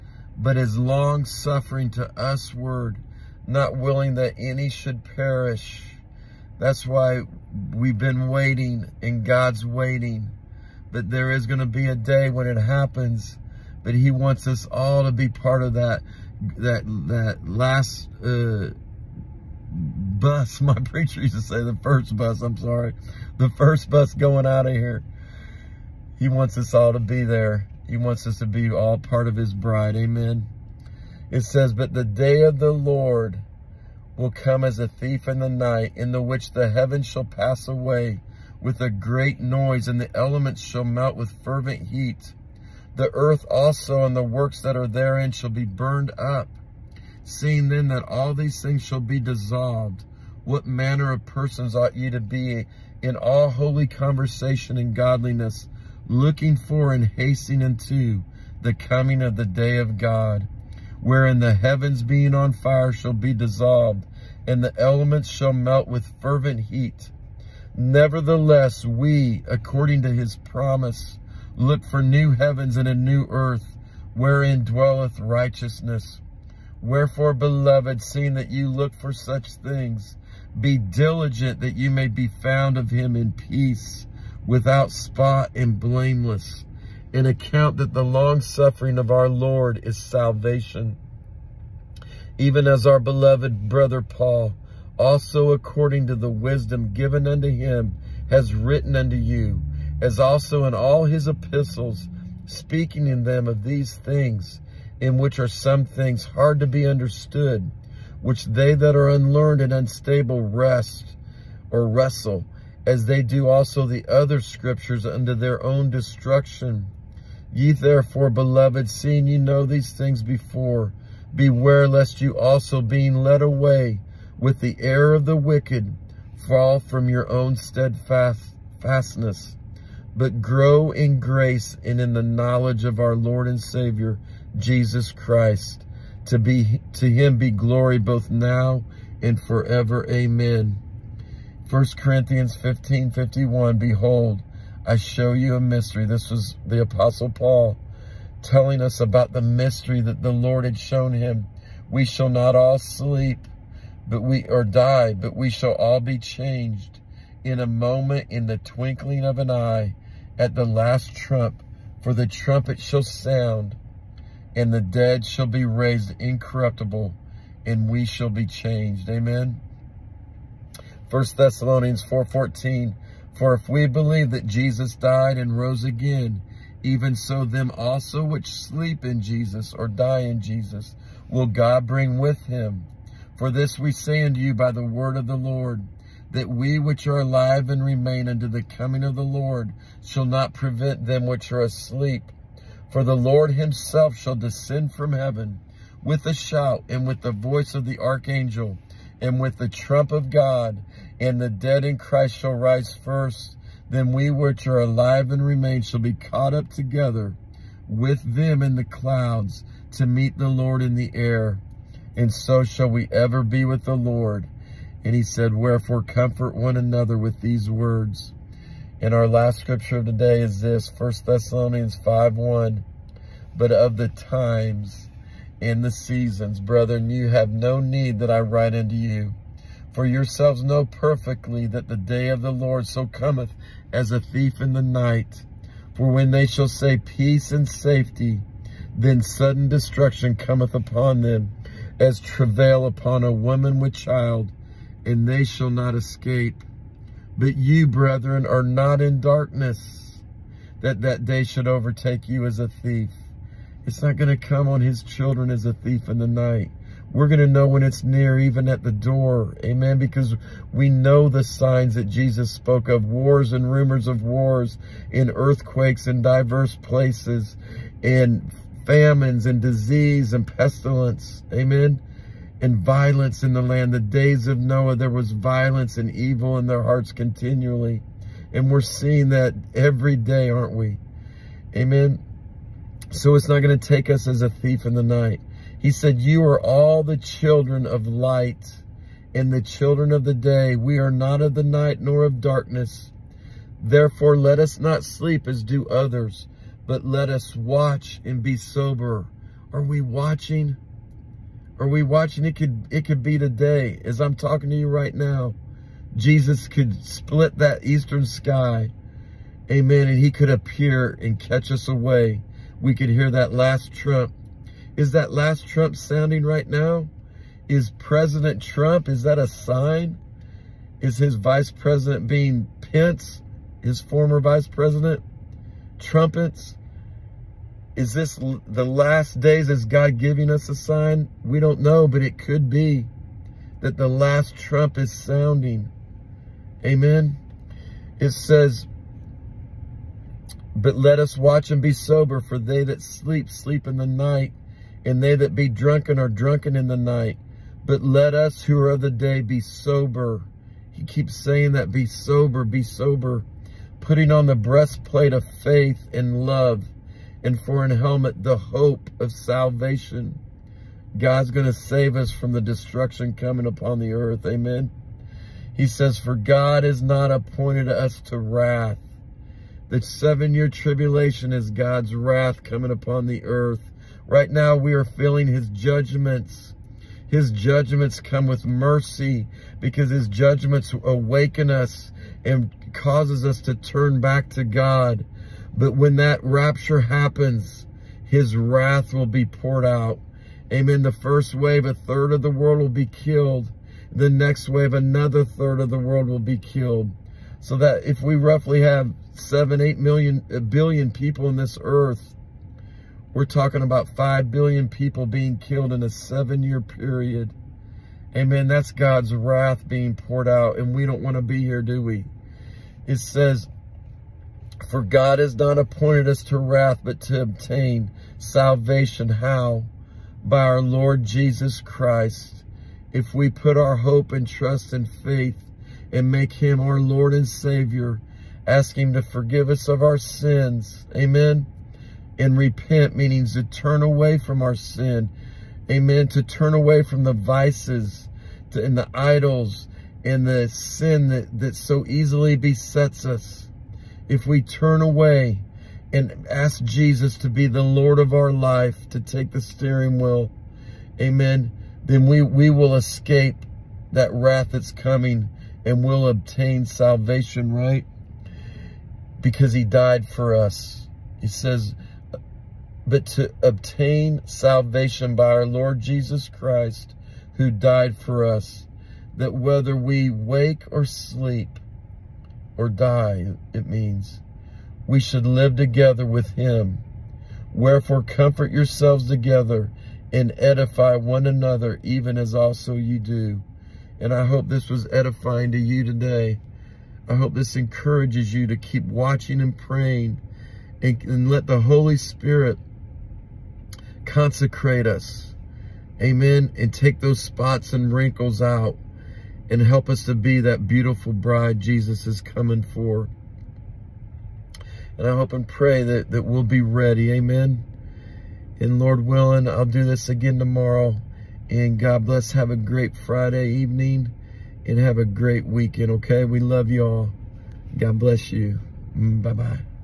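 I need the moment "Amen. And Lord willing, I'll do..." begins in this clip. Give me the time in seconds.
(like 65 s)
507 s.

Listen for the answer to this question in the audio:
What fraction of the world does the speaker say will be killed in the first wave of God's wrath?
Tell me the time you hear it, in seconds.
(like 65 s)
391 s.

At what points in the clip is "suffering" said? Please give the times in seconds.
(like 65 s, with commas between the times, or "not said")
0 s, 88 s.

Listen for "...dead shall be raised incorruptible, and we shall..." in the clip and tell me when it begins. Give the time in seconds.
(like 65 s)
164 s.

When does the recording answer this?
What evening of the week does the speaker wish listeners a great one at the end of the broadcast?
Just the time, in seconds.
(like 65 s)
513 s.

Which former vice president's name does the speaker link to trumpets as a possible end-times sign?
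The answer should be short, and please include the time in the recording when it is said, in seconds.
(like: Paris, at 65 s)
Pence, at 322 s.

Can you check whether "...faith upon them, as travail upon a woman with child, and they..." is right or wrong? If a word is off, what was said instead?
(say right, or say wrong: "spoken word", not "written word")
wrong: "cometh", not "faith".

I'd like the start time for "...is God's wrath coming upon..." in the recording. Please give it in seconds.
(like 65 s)
371 s.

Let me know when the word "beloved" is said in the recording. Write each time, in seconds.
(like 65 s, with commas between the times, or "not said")
77 s, 92 s, 118 s.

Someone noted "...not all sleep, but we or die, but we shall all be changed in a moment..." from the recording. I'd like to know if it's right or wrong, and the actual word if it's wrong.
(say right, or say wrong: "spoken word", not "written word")
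right.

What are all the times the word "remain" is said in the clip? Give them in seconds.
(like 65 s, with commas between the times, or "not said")
187 s, 205 s.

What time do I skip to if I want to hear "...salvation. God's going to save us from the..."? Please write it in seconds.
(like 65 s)
359 s.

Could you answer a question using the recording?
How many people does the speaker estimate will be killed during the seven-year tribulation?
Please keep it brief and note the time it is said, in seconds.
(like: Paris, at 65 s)
5 billion, at 404 s.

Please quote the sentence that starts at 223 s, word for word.
But of the times and the seasons, brethren, you have no need that I write unto you.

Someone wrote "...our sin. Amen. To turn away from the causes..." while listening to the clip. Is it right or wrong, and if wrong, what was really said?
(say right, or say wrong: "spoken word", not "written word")
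wrong: "vices", not "causes".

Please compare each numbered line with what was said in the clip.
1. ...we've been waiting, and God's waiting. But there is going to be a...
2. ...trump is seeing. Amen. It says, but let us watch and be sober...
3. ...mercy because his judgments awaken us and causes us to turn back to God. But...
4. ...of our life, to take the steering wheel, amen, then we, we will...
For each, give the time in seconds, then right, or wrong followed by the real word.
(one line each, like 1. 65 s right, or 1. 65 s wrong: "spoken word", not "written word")
1. 7 s right
2. 334 s wrong: "sounding", not "seeing"
3. 378 s right
4. 448 s right.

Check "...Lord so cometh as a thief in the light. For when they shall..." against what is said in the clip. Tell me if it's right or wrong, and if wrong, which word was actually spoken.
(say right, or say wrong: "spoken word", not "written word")
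wrong: "night", not "light".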